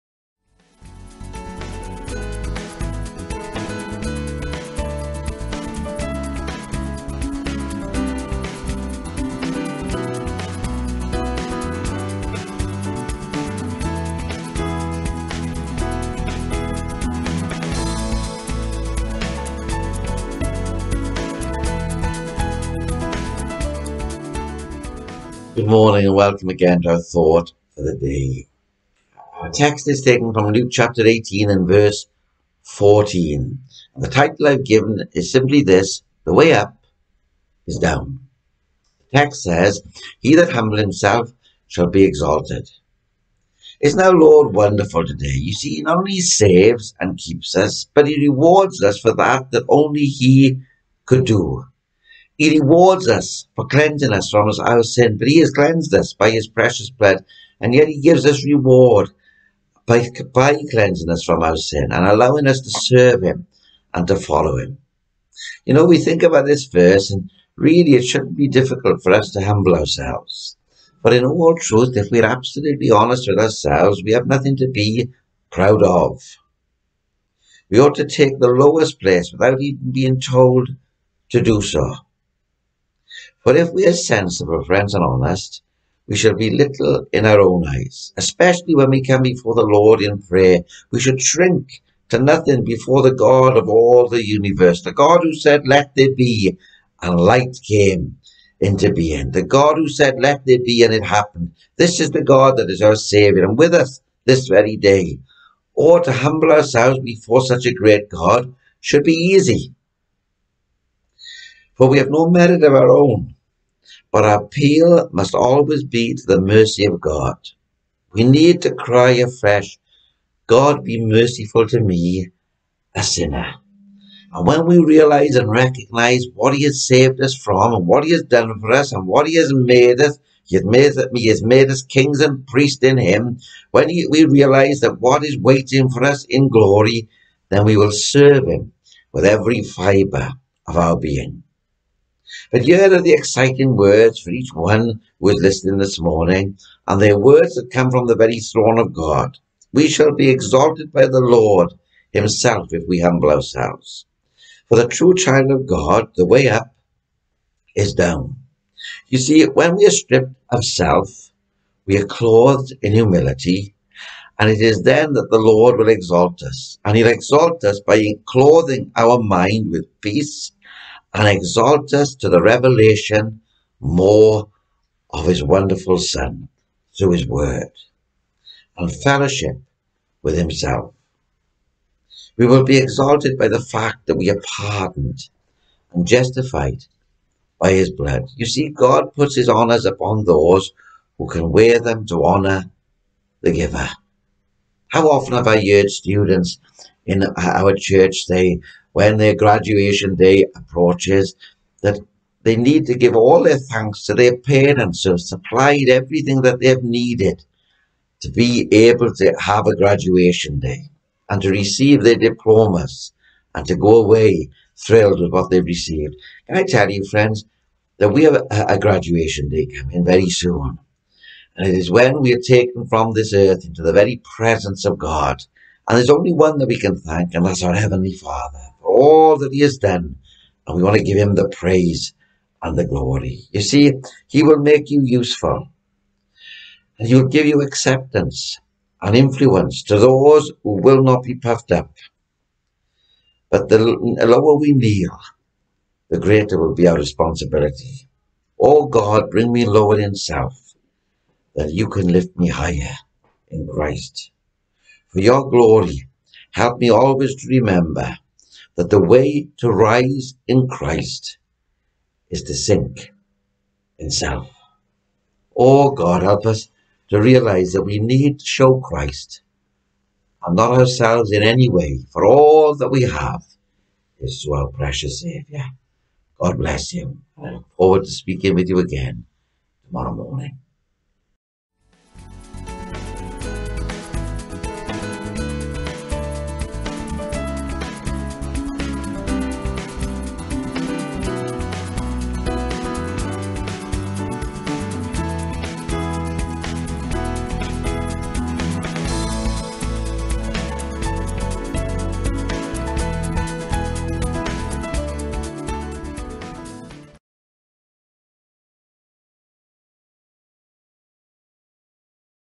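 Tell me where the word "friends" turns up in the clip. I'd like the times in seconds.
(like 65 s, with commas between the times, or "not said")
84 s, 217 s.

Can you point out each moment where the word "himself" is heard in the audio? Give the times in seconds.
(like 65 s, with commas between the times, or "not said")
40 s, 152 s, 180 s.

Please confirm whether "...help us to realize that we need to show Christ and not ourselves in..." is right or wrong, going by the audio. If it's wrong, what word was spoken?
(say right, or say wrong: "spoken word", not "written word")
right.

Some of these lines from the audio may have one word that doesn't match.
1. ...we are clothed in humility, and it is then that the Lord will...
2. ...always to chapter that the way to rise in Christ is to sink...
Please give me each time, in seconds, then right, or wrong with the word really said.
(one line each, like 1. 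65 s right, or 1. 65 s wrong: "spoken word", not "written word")
1. 161 s right
2. 256 s wrong: "remember", not "chapter".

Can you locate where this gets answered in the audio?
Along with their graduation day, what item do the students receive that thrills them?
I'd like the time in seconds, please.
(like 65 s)
212 s.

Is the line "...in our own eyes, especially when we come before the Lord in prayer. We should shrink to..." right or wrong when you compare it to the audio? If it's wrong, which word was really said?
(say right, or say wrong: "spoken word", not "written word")
right.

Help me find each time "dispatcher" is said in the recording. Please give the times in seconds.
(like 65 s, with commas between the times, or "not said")
not said.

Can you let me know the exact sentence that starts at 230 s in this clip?
And we want to give Him the praise and the glory.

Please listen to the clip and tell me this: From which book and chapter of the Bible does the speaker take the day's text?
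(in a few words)
Luke 18.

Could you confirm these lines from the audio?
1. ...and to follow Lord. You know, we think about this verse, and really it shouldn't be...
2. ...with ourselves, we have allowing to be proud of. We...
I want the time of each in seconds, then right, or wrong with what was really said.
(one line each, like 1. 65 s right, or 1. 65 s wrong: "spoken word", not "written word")
1. 63 s wrong: "Him", not "Lord"
2. 73 s wrong: "nothing", not "allowing".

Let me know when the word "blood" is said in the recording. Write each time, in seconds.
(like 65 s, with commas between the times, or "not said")
56 s, 187 s.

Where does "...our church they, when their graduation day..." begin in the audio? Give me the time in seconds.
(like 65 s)
197 s.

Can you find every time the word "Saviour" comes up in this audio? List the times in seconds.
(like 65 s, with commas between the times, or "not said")
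102 s, 275 s.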